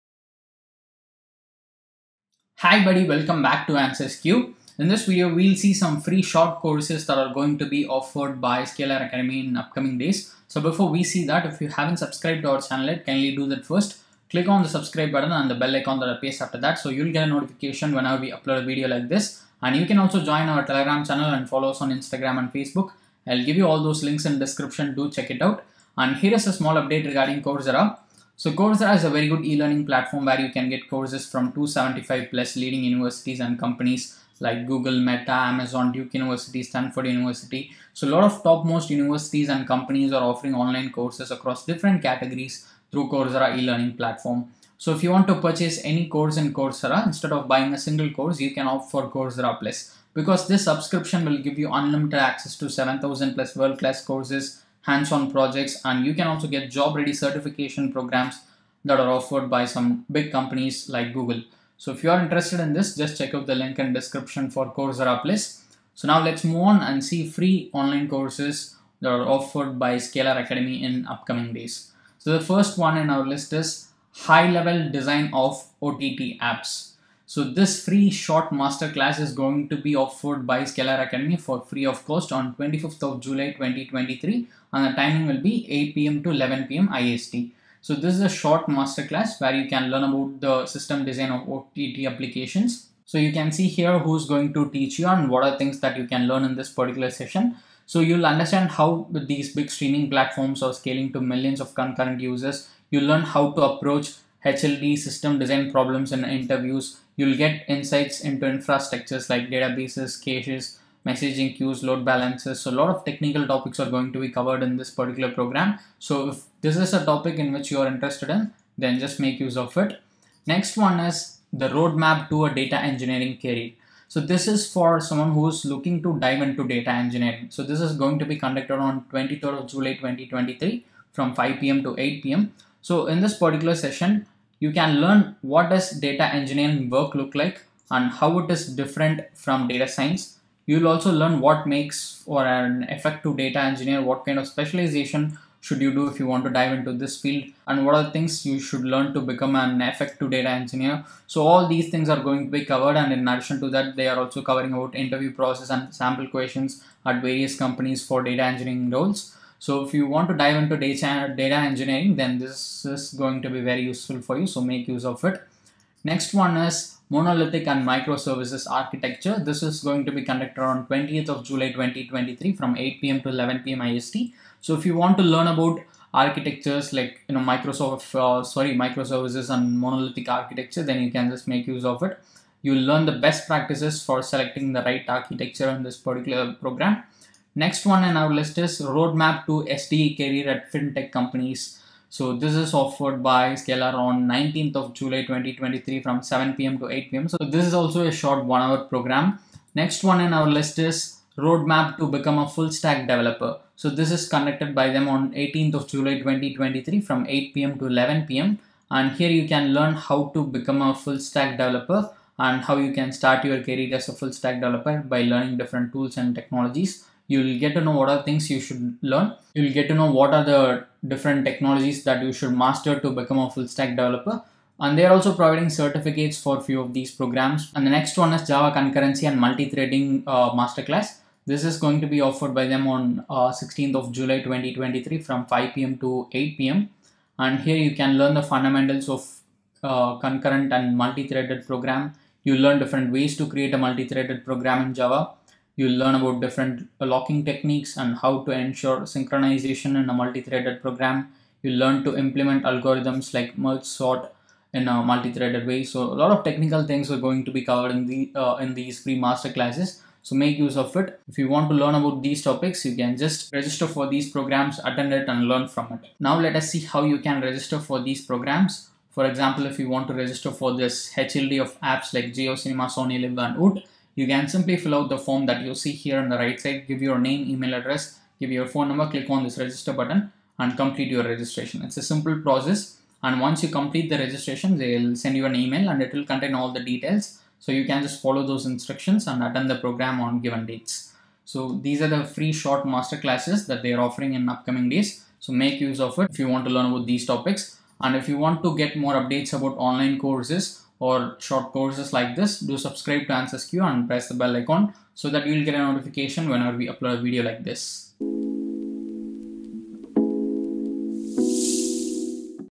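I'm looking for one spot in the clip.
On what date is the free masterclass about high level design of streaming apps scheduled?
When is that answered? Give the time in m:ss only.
1:22.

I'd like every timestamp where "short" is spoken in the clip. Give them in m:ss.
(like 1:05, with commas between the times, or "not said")
0:06, 1:18, 1:28, 3:18, 4:52, 5:01.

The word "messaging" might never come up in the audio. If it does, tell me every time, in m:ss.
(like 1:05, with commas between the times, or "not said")
1:51.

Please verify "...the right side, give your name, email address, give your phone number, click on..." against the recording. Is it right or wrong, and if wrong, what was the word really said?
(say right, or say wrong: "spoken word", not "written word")
right.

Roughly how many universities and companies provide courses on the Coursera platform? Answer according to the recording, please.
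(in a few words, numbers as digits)
275+.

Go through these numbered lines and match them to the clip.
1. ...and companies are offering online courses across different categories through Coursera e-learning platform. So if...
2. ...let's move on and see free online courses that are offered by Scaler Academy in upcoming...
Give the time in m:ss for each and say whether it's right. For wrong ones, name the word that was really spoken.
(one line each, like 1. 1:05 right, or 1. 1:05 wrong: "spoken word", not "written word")
1. 0:39 right
2. 1:06 right.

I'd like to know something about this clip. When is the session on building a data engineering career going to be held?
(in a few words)
23 July 2023.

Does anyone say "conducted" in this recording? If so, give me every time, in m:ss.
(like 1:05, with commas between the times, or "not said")
2:08, 2:50, 3:24.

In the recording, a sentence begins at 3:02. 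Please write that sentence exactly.
You'll learn the best practices for selecting the right architecture in this particular program.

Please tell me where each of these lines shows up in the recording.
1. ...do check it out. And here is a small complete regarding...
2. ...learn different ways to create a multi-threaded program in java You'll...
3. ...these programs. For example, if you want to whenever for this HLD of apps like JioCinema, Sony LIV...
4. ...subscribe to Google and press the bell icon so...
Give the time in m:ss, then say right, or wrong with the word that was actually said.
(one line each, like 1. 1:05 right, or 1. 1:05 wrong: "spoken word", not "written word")
1. 0:24 wrong: "update", not "complete"
2. 4:02 right
3. 4:28 wrong: "register", not "whenever"
4. 5:02 wrong: "AnswersQ", not "Google".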